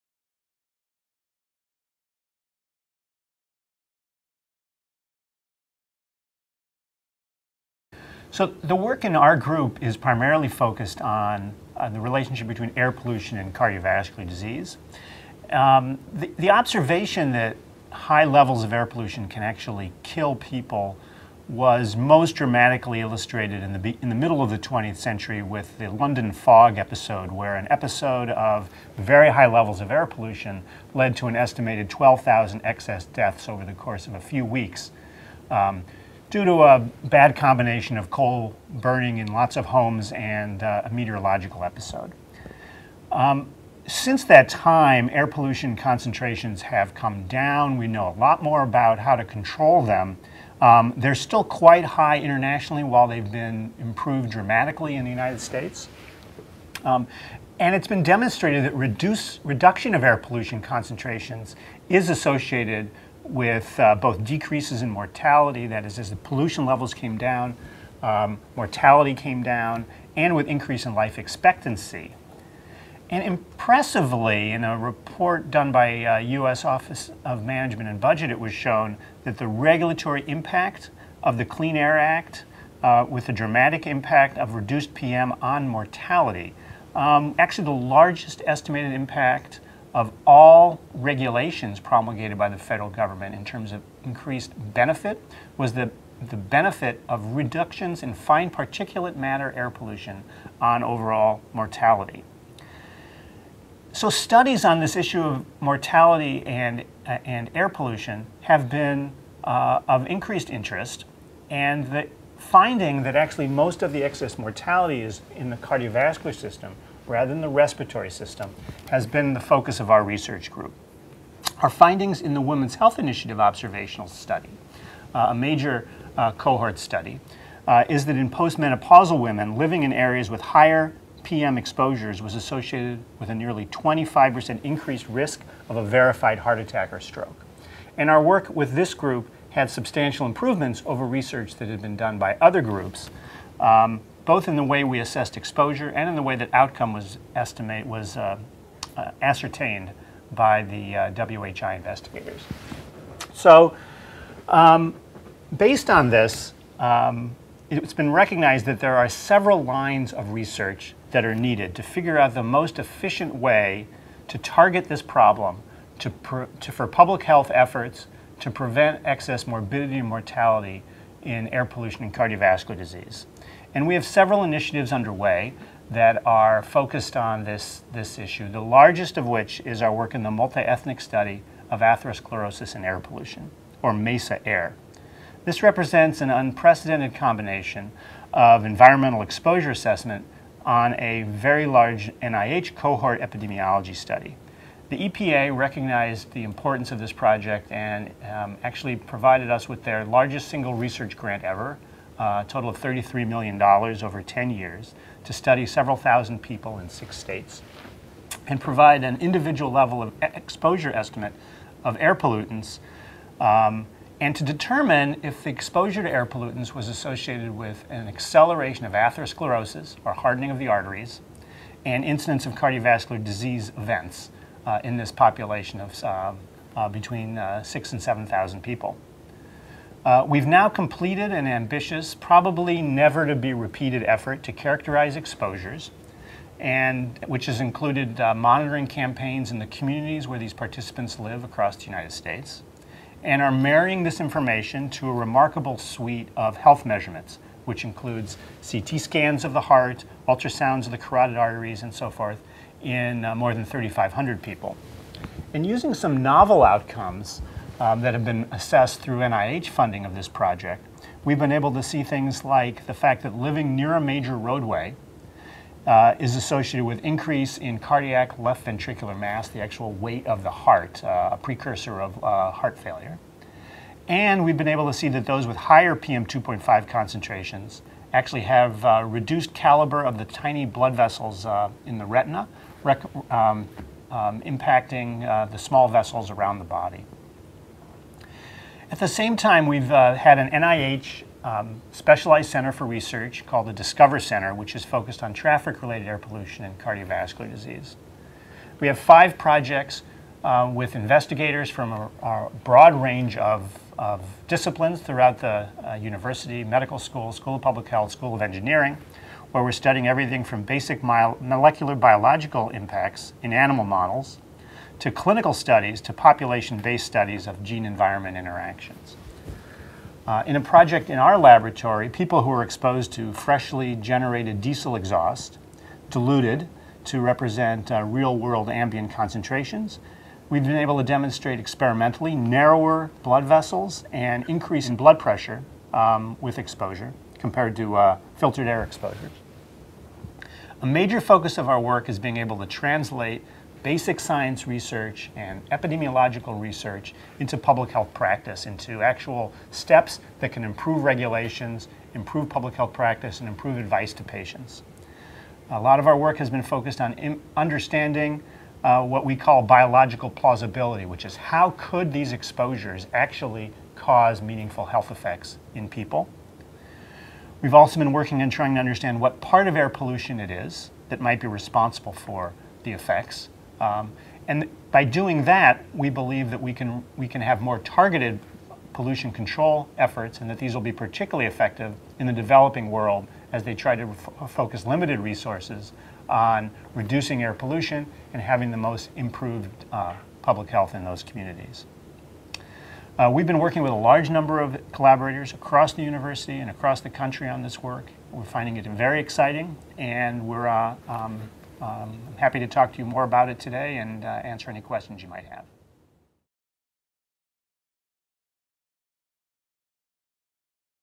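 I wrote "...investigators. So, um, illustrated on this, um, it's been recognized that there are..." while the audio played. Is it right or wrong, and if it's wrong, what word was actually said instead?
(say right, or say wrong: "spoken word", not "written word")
wrong: "based", not "illustrated".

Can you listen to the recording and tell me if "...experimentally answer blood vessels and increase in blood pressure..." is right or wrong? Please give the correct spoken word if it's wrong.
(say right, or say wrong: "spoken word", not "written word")
wrong: "narrower", not "answer".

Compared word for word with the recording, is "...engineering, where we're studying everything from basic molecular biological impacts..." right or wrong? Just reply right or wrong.
right.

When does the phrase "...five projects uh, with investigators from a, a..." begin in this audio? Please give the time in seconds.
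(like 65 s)
298 s.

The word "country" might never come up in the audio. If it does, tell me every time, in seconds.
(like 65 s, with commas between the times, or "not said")
397 s.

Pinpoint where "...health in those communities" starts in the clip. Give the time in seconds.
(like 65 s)
390 s.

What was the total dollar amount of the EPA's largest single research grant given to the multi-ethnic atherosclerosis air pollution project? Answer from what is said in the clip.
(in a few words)
$33 million.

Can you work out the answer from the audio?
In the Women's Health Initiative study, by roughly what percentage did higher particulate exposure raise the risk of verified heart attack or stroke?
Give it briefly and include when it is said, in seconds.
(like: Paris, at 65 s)
25%, at 133 s.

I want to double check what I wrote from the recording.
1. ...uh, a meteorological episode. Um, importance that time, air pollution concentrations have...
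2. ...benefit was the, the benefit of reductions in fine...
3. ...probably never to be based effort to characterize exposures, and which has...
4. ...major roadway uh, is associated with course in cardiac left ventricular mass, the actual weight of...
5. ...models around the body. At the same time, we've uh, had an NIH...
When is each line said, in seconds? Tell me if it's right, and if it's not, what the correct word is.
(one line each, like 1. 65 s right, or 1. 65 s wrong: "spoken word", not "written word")
1. 40 s wrong: "since", not "importance"
2. 94 s right
3. 232 s wrong: "repeated", not "based"
4. 264 s wrong: "increase", not "course"
5. 285 s wrong: "vessels", not "models".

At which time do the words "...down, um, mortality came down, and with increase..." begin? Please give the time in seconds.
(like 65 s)
67 s.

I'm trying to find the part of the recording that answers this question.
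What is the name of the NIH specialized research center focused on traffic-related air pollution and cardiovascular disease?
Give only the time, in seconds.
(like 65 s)
293 s.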